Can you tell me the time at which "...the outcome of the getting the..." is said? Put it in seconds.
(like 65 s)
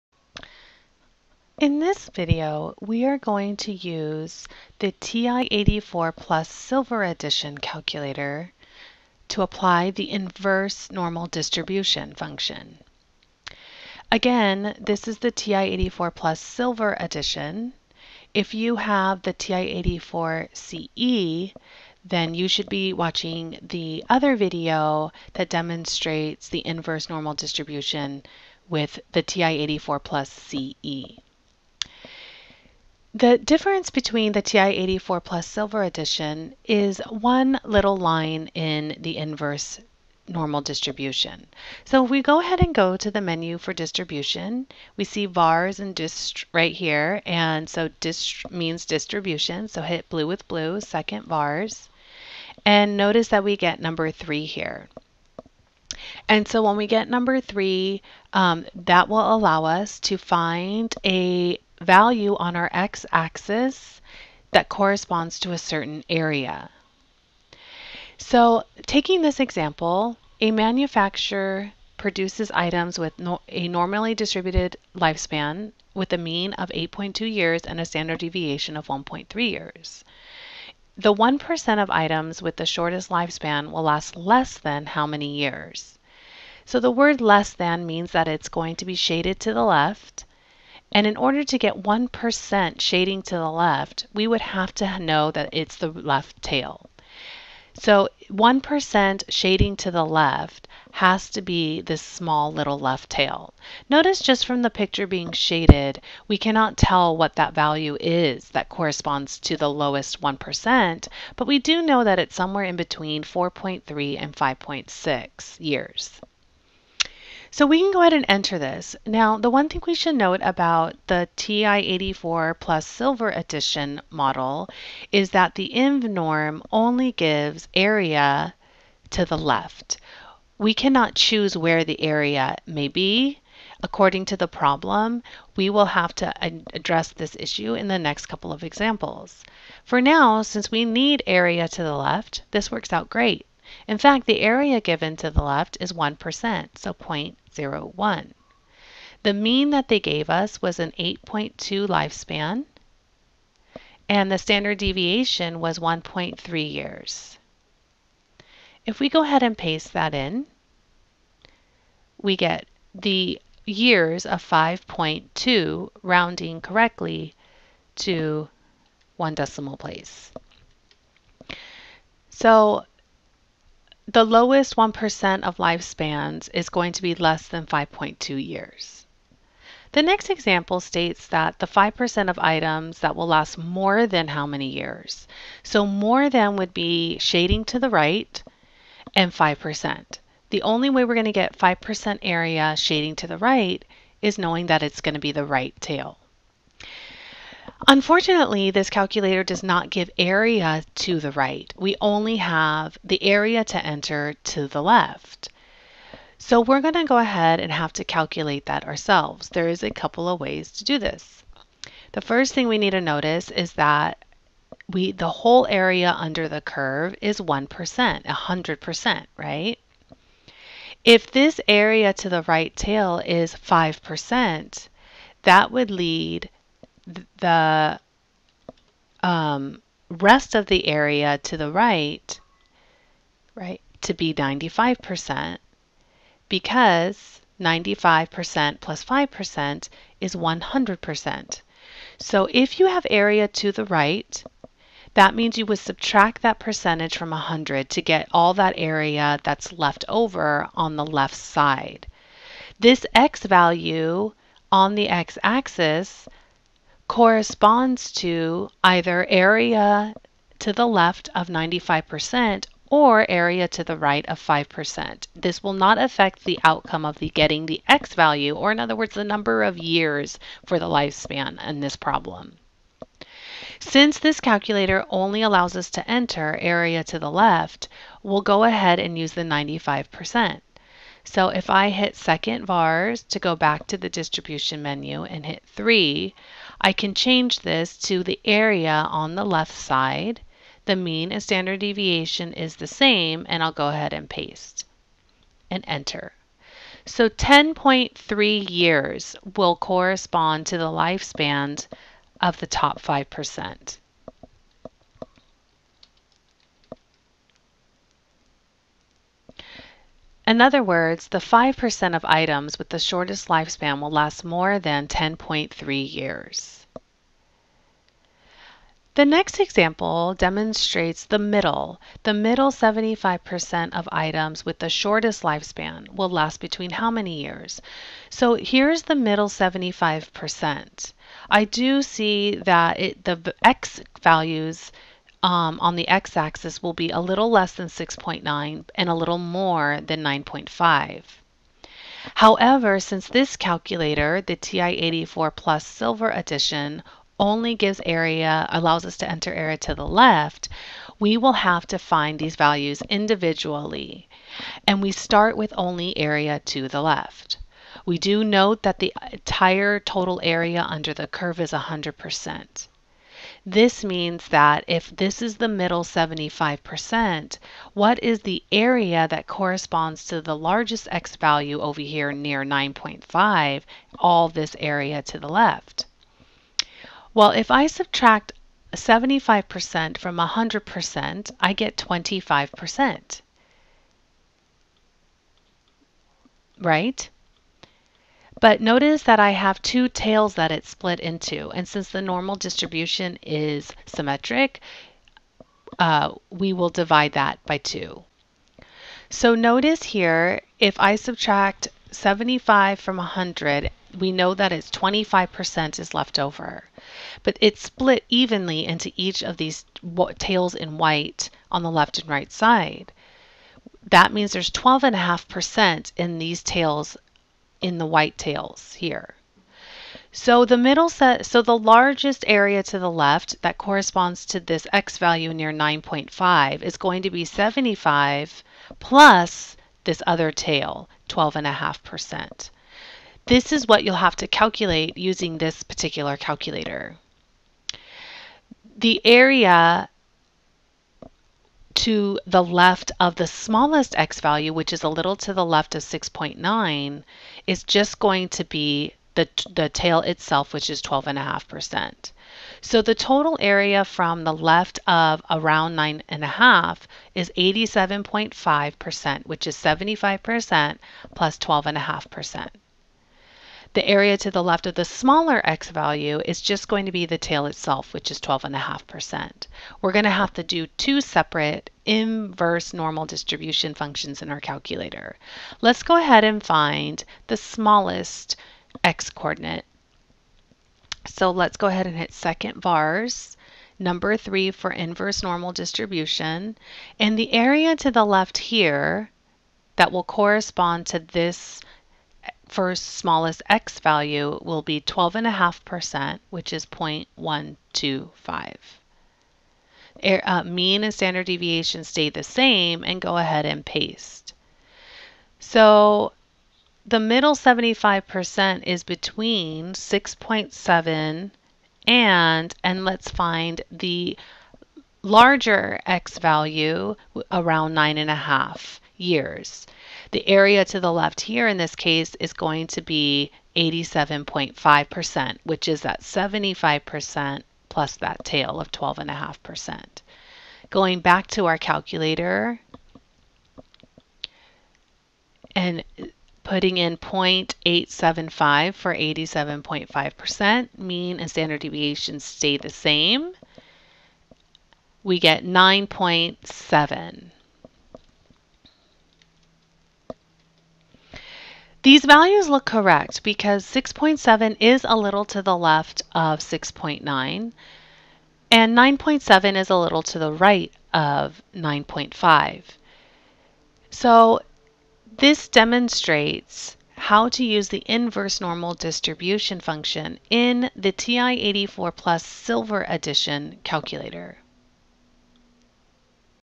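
266 s.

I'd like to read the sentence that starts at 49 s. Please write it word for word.
So hit blue with blue, second vars.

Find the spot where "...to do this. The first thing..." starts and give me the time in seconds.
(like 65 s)
210 s.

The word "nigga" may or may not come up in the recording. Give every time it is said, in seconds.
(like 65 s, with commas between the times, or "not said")
not said.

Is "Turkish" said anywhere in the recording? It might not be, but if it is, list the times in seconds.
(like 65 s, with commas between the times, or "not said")
not said.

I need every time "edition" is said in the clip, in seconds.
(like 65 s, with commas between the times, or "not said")
7 s, 16 s, 35 s, 123 s, 346 s, 573 s.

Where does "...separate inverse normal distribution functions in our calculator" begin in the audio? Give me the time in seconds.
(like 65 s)
471 s.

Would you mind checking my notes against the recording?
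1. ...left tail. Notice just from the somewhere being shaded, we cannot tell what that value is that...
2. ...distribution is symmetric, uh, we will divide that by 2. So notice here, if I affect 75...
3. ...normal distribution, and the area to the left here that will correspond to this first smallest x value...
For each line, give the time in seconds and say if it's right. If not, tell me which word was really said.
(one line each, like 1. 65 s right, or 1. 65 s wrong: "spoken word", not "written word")
1. 102 s wrong: "picture", not "somewhere"
2. 392 s wrong: "subtract", not "affect"
3. 485 s right.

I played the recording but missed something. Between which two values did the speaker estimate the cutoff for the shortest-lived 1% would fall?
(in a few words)
4.3 and 5.6 years.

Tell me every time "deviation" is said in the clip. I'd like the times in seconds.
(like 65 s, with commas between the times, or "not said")
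78 s, 154 s, 291 s, 501 s, 541 s.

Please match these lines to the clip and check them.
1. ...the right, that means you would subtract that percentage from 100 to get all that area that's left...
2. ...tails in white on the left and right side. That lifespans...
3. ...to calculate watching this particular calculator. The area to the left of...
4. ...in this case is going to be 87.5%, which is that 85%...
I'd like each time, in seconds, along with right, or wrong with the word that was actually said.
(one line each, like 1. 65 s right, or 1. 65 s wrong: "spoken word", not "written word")
1. 243 s right
2. 410 s wrong: "means", not "lifespans"
3. 434 s wrong: "using", not "watching"
4. 521 s wrong: "75", not "85".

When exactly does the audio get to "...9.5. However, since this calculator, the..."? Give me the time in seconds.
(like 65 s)
340 s.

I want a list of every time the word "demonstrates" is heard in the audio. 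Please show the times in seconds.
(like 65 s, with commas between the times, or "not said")
25 s, 320 s, 565 s.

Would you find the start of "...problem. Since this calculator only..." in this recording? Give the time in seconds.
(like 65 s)
271 s.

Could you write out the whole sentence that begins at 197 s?
Unfortunately, this calculator does not give area to the right.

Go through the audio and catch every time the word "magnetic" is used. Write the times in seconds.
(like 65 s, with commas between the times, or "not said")
not said.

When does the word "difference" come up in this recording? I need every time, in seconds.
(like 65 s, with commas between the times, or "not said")
33 s.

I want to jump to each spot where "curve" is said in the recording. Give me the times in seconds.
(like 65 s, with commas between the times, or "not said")
216 s, 361 s.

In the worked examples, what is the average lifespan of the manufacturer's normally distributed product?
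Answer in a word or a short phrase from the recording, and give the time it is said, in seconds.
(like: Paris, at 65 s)
8.2 years, at 76 s.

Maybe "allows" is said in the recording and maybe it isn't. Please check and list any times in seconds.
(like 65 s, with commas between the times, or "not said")
59 s, 275 s, 348 s.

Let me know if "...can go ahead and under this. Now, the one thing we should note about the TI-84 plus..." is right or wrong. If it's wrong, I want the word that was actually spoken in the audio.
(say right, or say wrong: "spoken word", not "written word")
wrong: "enter", not "under".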